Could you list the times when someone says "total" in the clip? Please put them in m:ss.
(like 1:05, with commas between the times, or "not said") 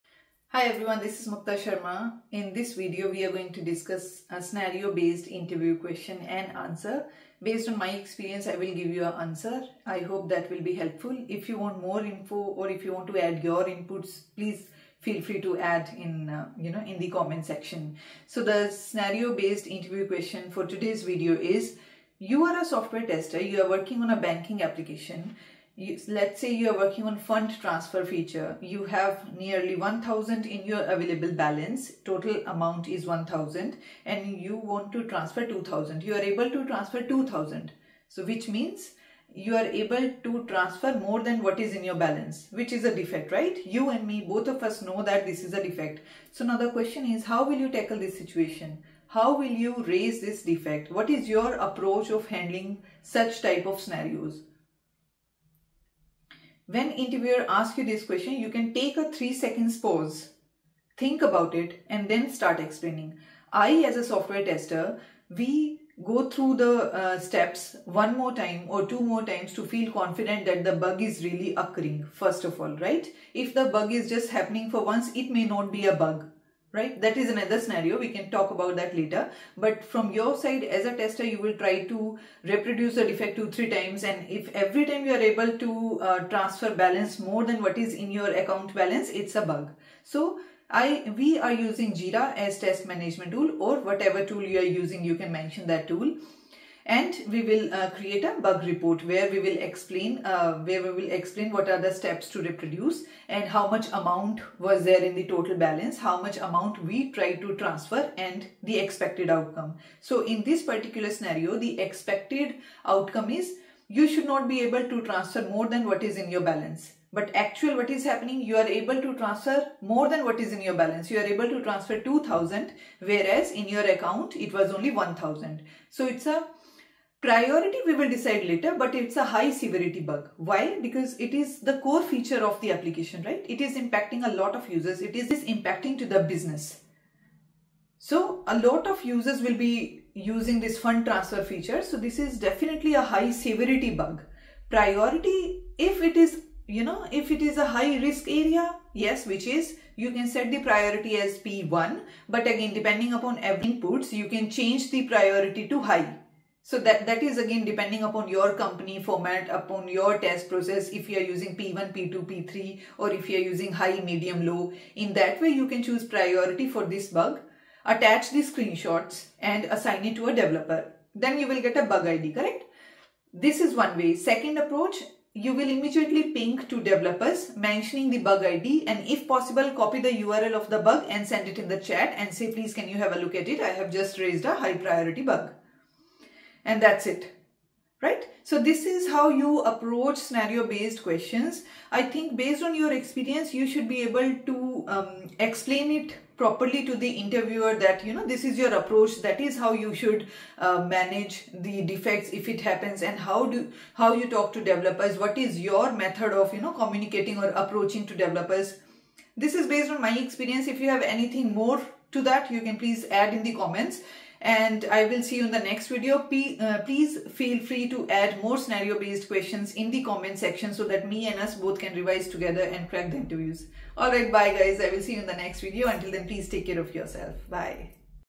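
0:32, 1:45.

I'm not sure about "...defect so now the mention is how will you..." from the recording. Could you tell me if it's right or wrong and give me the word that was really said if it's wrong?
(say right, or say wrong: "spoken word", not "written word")
wrong: "question", not "mention".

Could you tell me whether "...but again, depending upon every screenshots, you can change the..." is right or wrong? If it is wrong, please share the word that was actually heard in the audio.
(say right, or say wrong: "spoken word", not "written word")
wrong: "inputs", not "screenshots".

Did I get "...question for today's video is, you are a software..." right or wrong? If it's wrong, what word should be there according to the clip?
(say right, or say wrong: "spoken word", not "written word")
right.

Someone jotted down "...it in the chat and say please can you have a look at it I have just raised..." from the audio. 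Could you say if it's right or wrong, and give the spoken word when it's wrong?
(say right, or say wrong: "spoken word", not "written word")
right.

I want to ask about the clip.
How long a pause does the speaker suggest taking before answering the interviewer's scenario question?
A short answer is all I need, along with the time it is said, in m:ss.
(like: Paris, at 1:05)
3 seconds, at 0:59.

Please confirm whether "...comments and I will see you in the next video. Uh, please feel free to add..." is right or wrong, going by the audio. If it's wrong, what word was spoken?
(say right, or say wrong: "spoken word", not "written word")
right.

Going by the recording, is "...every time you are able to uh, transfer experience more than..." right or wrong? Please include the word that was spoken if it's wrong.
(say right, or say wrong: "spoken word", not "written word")
wrong: "balance", not "experience".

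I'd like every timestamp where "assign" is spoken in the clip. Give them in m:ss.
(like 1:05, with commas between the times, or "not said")
2:49.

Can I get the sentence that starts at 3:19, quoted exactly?
That is how you should uh, manage the defects if it happens and how do, how you talk to developers.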